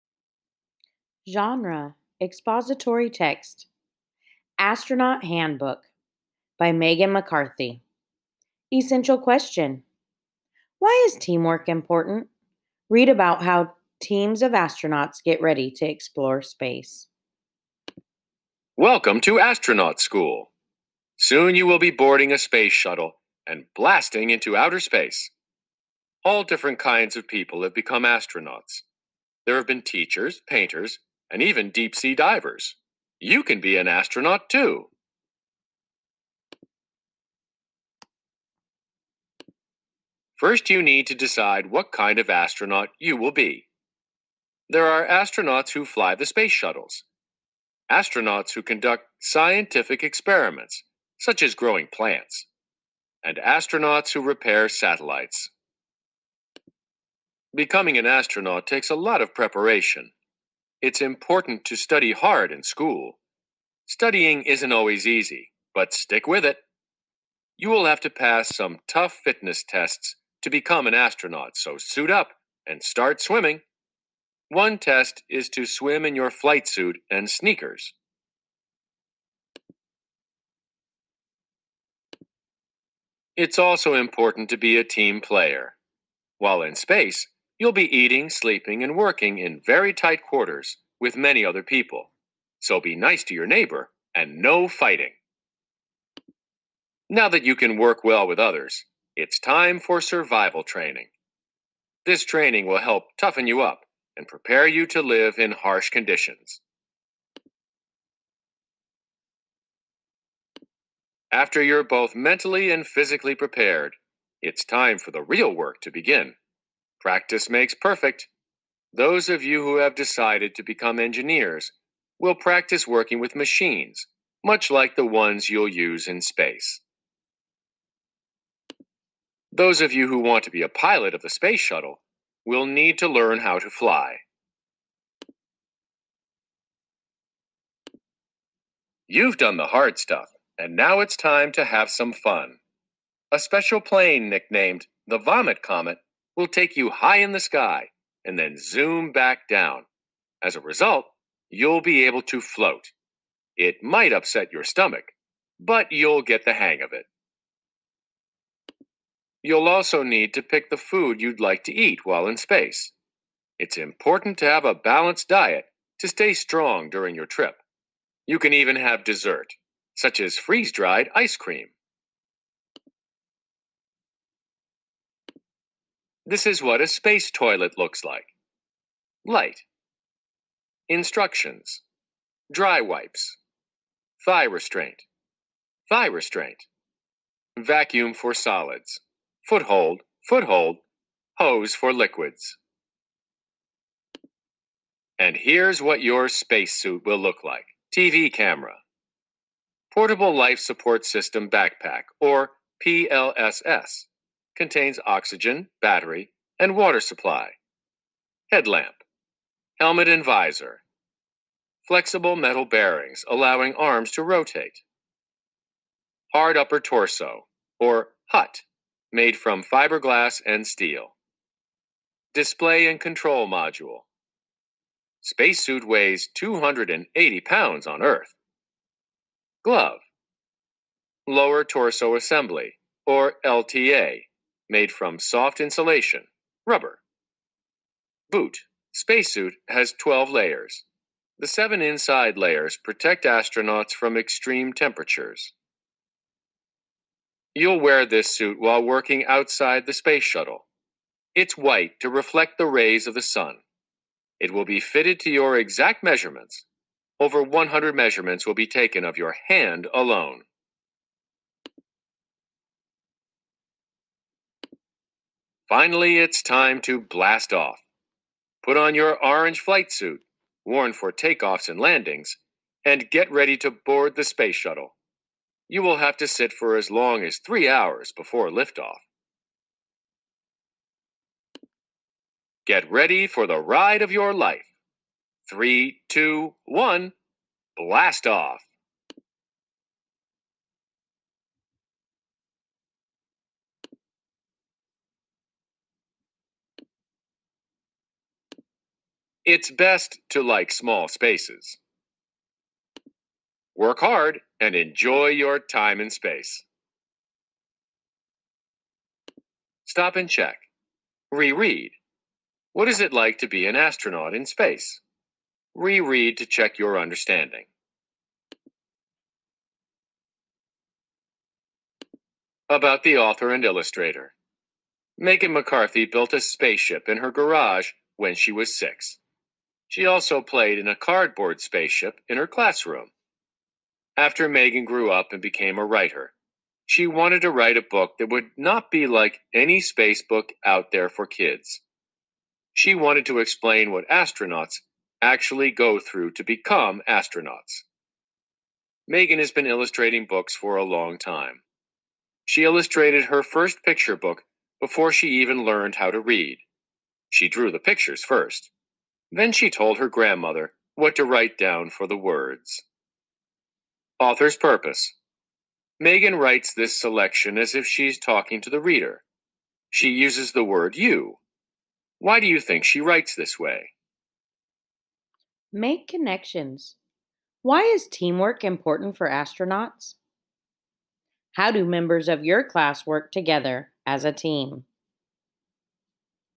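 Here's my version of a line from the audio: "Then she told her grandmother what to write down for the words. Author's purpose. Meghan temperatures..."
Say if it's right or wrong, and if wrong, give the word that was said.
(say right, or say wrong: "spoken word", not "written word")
wrong: "writes", not "temperatures".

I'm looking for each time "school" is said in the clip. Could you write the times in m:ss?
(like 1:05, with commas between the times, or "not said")
0:19, 1:02.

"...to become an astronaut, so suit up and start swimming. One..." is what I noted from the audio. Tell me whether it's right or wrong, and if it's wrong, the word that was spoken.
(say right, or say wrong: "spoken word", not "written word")
right.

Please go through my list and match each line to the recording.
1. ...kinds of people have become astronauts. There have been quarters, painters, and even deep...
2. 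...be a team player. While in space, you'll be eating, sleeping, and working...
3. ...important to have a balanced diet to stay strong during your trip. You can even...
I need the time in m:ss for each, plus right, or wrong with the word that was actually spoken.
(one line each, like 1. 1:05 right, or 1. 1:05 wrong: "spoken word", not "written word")
1. 0:26 wrong: "teachers", not "quarters"
2. 1:24 right
3. 2:43 right.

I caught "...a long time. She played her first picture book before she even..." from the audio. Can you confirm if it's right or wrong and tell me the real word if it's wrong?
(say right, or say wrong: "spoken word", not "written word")
wrong: "illustrated", not "played".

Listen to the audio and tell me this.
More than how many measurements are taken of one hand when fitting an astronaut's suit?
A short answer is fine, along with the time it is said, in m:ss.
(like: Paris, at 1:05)
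100, at 4:17.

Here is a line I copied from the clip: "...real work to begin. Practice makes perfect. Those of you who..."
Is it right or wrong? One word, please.
right.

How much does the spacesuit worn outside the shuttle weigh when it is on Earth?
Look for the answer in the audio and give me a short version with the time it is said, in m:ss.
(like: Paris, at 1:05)
280 pounds, at 3:46.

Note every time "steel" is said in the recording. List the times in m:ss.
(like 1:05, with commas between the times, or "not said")
3:40.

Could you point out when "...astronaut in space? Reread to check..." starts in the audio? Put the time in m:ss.
5:13.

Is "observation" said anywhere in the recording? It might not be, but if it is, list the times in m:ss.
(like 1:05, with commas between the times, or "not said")
not said.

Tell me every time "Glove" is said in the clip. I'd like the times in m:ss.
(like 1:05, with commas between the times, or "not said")
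3:49.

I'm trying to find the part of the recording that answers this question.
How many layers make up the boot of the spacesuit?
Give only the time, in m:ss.
3:59.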